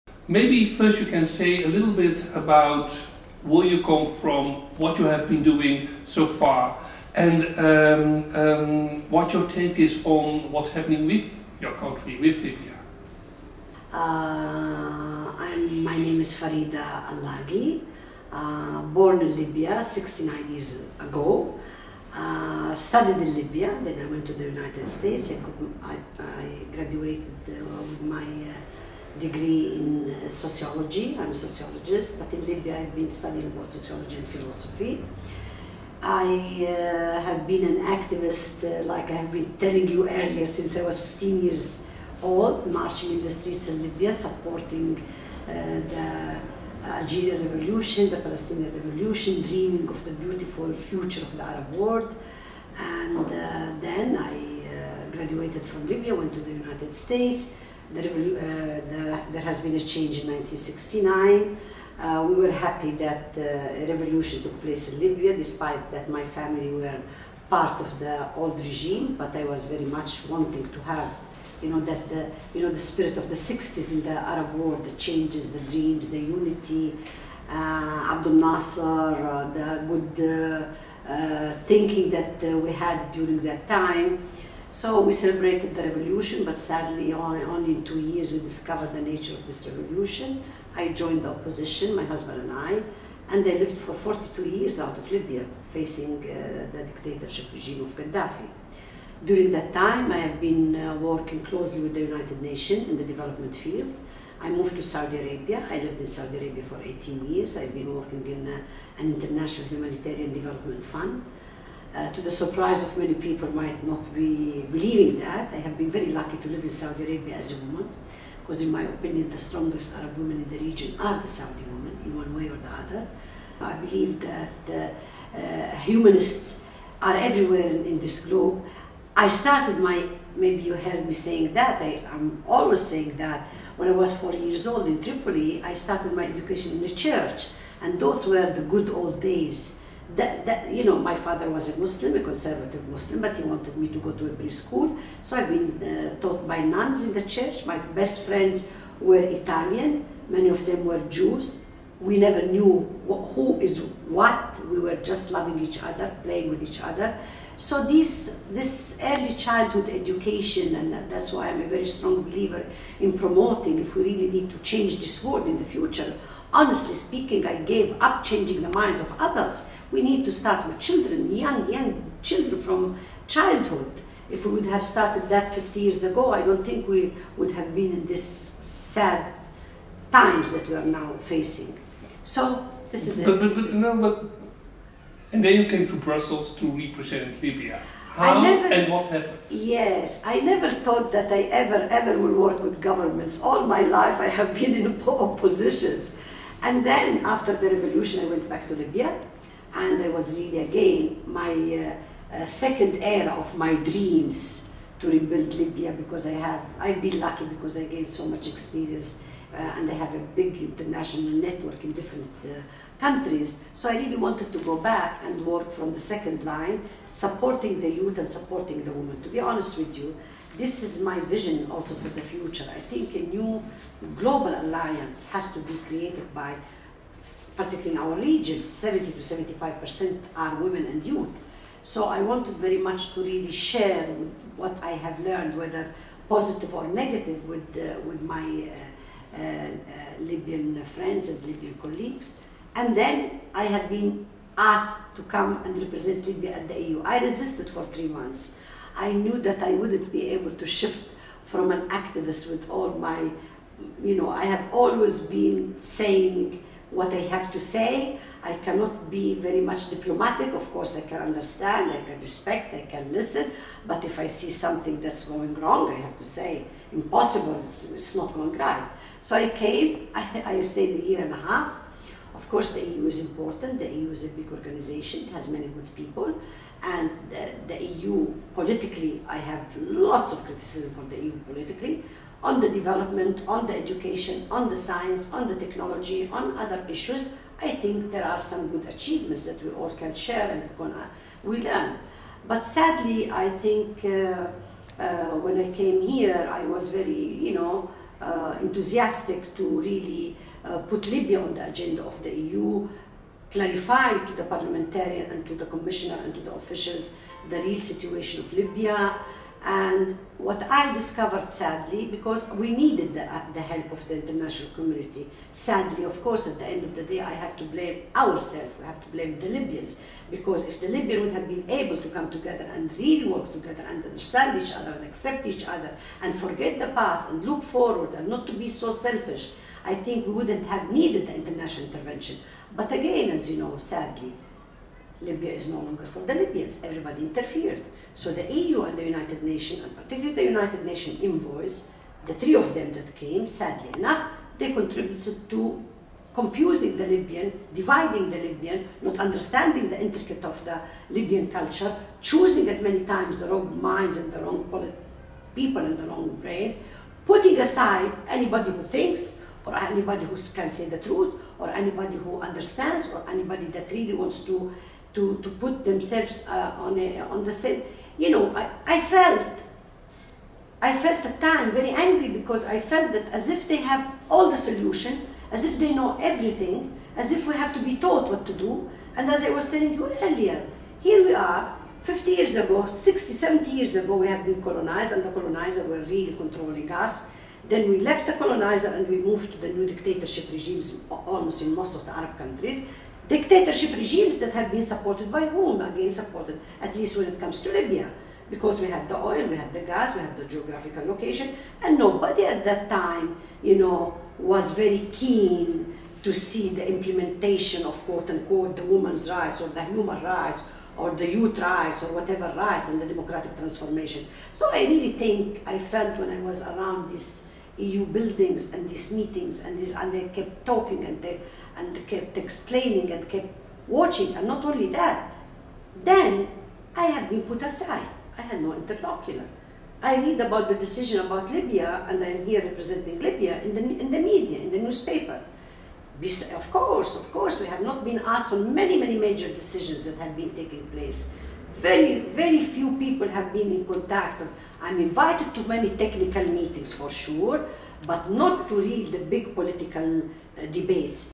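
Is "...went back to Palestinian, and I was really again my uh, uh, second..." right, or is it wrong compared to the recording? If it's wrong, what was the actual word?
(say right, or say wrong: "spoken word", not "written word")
wrong: "Libya", not "Palestinian".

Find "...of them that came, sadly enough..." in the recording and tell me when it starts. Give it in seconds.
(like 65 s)
342 s.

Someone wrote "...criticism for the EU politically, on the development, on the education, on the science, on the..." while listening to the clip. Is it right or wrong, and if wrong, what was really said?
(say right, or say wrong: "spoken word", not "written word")
right.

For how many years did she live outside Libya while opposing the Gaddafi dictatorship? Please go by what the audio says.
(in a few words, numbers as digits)
42.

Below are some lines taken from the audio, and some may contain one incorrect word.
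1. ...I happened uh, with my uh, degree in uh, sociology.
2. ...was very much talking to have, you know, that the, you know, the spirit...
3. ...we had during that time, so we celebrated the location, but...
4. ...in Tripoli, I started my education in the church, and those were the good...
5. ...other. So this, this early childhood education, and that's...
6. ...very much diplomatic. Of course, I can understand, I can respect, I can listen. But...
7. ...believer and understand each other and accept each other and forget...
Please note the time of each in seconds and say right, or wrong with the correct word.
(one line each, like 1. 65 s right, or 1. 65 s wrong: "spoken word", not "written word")
1. 26 s wrong: "graduated", not "happened"
2. 69 s wrong: "wanting", not "talking"
3. 82 s wrong: "revolution", not "location"
4. 134 s right
5. 156 s right
6. 259 s right
7. 323 s wrong: "together", not "believer".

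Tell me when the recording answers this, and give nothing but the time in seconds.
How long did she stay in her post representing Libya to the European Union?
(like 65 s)
271 s.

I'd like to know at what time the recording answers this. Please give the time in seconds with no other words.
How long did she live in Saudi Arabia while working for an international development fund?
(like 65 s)
106 s.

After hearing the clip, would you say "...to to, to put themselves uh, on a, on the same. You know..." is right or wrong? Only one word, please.
right.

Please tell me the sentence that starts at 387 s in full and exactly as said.
Then we left the colonizer and we moved to the new dictatorship regimes almost in most of the Arab countries.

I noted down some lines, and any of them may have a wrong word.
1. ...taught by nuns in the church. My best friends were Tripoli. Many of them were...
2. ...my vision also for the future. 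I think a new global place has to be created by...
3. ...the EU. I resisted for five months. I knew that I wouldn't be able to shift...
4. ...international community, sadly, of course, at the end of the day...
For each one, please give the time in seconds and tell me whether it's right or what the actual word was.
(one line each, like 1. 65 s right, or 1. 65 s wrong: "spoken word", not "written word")
1. 146 s wrong: "Italian", not "Tripoli"
2. 221 s wrong: "alliance", not "place"
3. 246 s wrong: "three", not "five"
4. 314 s right.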